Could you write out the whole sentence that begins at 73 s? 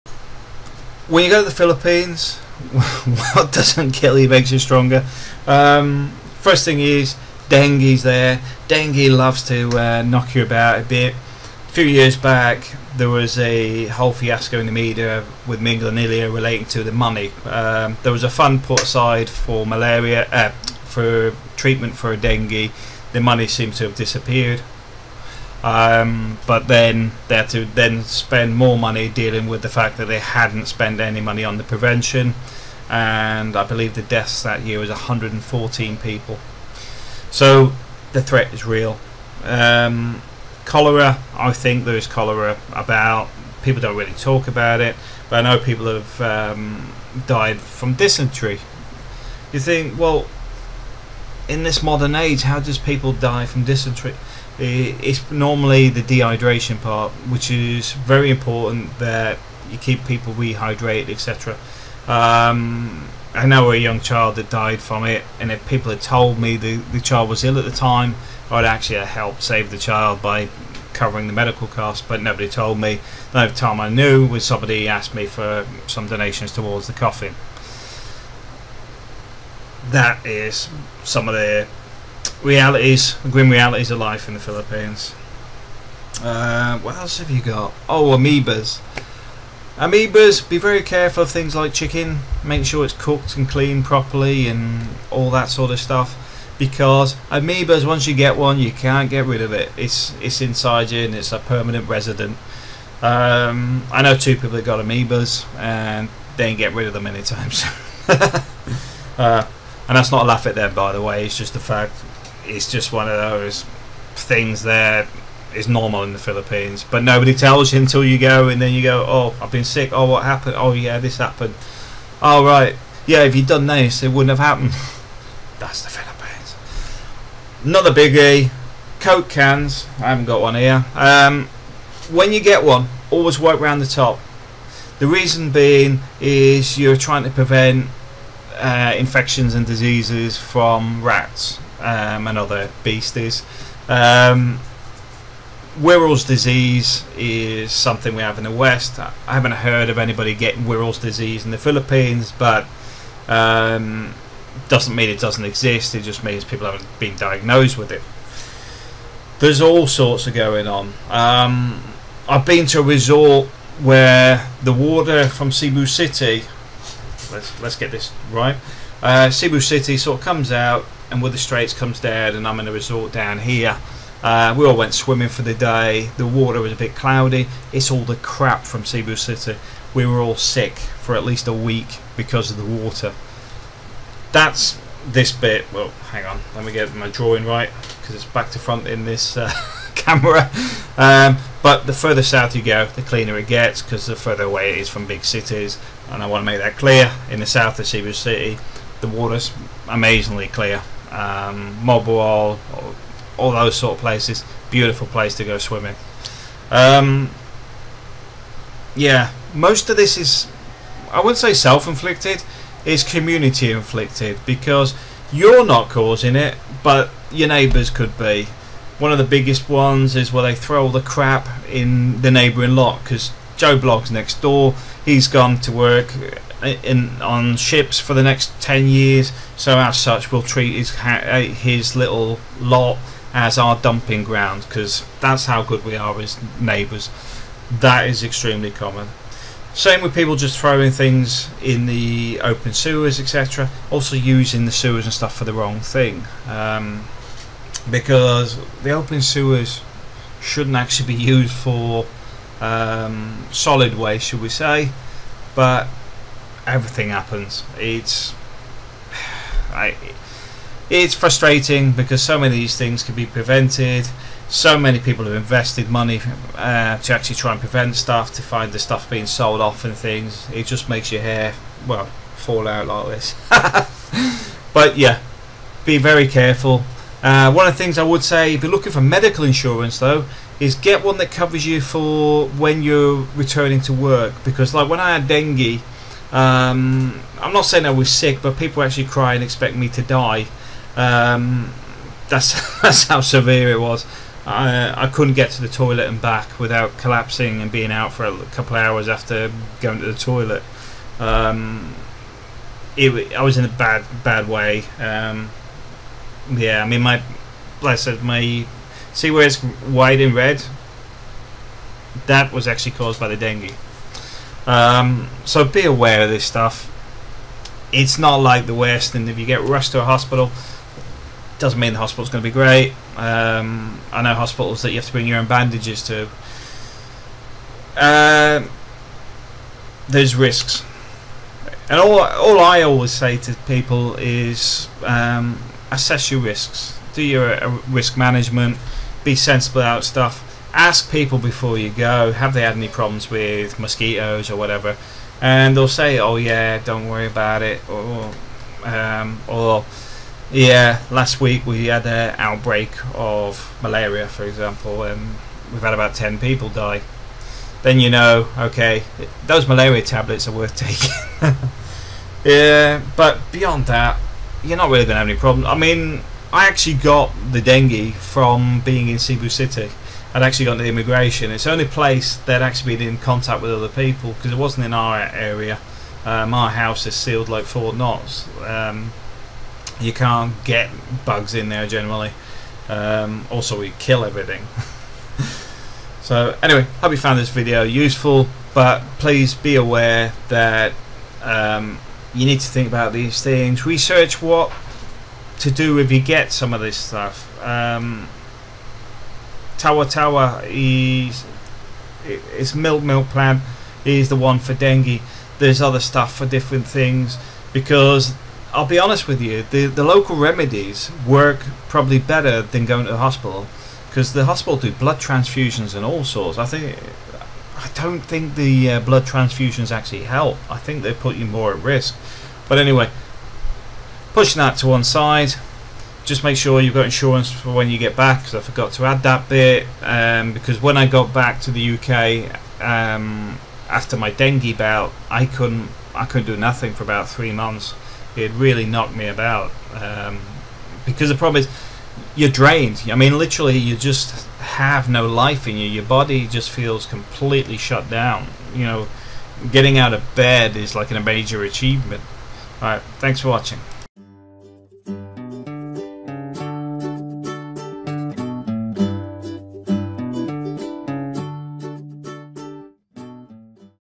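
The only time I knew was somebody asked me for some donations towards the coffin.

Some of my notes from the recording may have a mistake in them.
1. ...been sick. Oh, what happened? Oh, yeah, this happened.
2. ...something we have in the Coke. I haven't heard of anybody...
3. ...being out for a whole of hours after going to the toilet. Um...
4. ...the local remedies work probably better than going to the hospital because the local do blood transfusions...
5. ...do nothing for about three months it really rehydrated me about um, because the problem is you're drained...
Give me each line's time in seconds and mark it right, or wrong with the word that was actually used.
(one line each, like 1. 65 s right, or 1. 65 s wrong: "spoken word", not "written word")
1. 119 s right
2. 147 s wrong: "West", not "Coke"
3. 297 s wrong: "couple", not "whole"
4. 409 s wrong: "hospital", not "local"
5. 436 s wrong: "knocked", not "rehydrated".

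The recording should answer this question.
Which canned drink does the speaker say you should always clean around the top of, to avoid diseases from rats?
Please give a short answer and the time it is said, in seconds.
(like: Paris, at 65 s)
Coke, at 128 s.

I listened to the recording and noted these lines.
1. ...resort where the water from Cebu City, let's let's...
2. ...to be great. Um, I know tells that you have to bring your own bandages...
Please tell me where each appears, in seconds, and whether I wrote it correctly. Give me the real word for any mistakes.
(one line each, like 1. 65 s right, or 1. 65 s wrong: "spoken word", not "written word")
1. 162 s right
2. 322 s wrong: "hospitals", not "tells".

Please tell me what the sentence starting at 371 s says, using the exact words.
It's the only place they'd actually been in contact with other people because it wasn't in our area.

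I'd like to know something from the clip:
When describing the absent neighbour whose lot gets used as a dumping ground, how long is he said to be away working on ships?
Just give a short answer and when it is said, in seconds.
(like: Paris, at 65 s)
10 years, at 228 s.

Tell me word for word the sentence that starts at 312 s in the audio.
That was actually caused by the dengue.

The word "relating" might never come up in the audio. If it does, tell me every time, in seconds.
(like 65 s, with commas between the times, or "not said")
16 s.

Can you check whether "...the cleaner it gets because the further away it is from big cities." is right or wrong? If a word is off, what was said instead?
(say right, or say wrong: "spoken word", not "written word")
right.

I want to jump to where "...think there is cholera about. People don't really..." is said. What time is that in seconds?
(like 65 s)
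41 s.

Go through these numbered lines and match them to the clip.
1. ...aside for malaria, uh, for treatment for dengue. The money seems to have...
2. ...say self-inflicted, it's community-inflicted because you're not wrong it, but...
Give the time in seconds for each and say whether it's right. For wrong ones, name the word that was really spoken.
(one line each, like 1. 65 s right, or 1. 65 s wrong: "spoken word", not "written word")
1. 18 s right
2. 211 s wrong: "causing", not "wrong".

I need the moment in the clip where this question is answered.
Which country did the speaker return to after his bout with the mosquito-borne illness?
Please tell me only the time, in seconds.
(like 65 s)
431 s.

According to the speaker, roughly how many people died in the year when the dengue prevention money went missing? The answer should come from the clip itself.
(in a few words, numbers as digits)
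114.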